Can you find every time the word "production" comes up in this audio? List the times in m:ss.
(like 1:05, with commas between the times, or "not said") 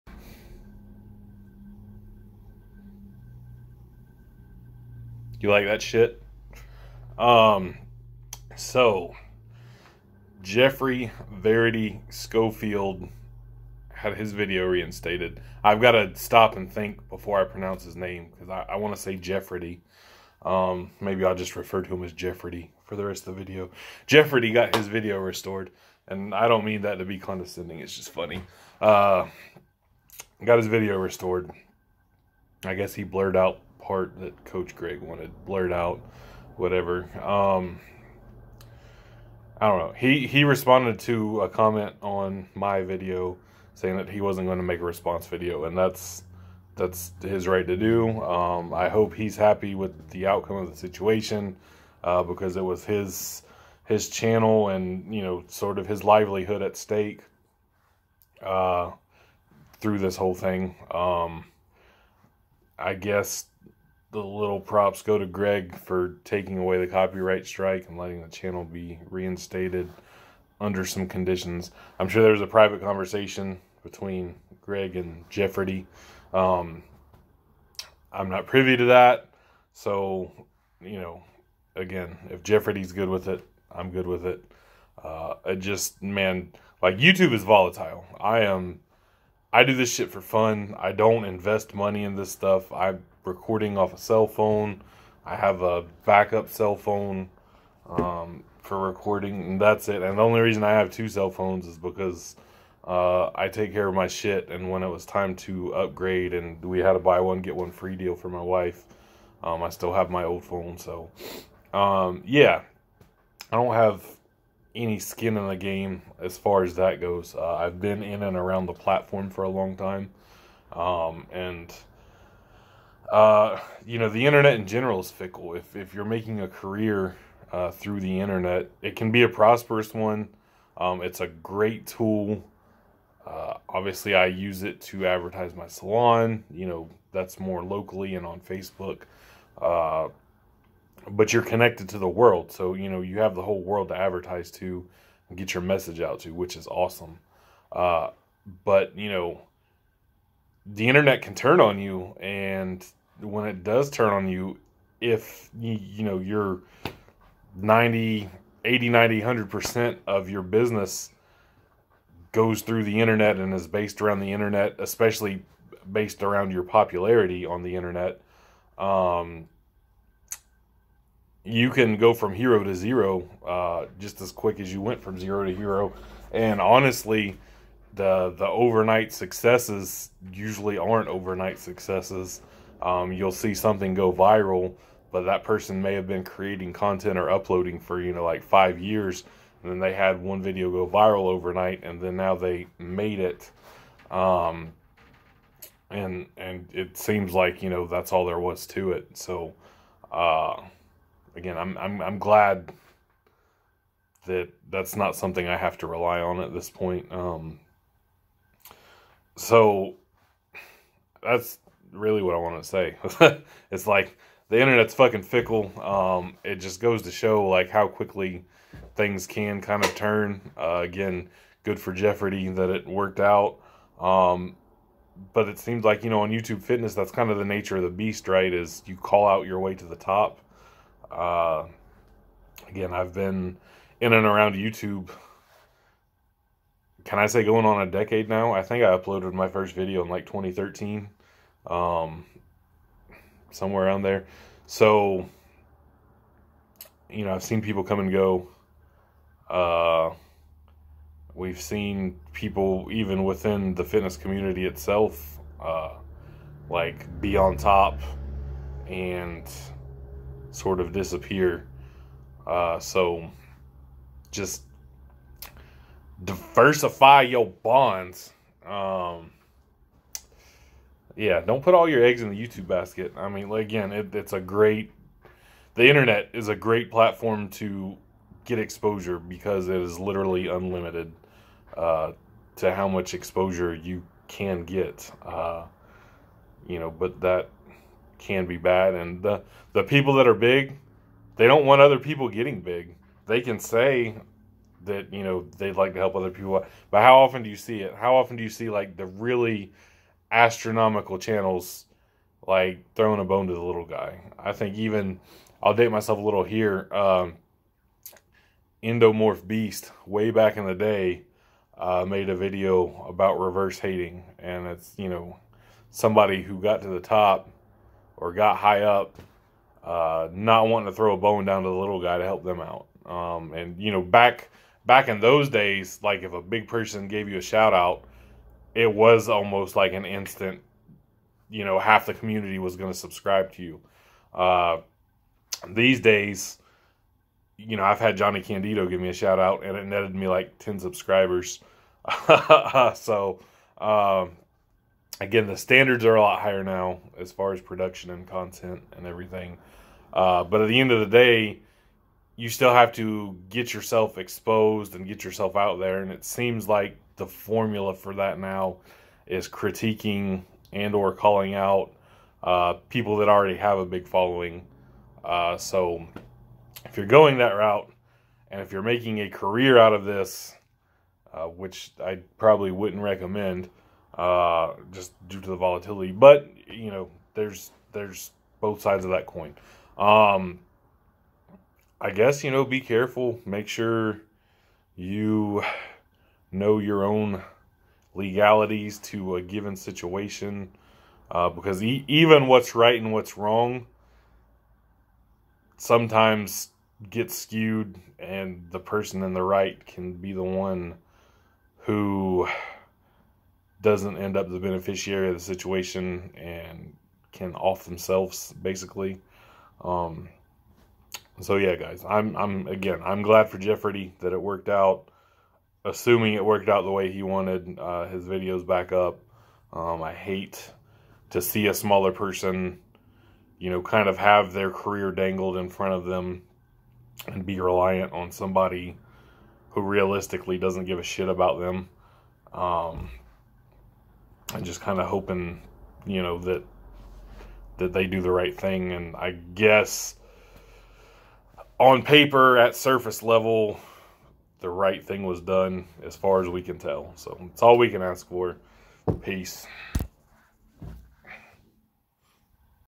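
5:47.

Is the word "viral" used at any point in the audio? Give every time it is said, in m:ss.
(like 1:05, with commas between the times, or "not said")
3:04, 3:10.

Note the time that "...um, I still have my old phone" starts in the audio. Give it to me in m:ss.
1:49.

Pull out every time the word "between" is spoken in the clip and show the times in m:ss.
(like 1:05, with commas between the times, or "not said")
1:13.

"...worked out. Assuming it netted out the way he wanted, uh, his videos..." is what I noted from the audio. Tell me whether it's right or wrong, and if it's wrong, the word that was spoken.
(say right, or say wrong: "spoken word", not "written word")
wrong: "worked", not "netted".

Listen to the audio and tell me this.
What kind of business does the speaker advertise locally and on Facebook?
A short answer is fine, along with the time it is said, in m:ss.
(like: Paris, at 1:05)
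salon, at 2:15.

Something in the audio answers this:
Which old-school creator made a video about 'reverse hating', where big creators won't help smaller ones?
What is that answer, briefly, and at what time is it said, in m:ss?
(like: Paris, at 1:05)
Endomorph Beast, at 5:08.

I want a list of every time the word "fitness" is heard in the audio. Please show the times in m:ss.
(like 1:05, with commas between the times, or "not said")
3:46, 4:13.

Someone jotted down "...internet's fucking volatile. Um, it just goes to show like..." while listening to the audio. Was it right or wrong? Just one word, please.
wrong.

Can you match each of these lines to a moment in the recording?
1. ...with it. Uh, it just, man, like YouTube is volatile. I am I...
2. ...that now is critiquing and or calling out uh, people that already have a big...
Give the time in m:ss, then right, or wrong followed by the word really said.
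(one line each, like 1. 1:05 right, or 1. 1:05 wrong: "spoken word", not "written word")
1. 1:24 right
2. 5:58 right.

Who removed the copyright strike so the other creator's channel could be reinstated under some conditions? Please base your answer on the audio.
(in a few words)
Coach Greg.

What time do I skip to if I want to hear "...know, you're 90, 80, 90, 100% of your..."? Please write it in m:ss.
2:36.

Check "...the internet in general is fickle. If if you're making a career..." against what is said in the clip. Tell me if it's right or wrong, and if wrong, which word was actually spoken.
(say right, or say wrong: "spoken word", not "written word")
right.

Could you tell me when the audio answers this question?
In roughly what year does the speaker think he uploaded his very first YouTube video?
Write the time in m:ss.
4:00.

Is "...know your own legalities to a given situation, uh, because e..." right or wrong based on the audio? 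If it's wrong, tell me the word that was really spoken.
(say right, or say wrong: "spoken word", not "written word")
right.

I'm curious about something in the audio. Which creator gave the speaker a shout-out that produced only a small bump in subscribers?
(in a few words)
Johnny Candido.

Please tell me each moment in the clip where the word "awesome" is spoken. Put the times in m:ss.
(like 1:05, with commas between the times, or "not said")
2:26.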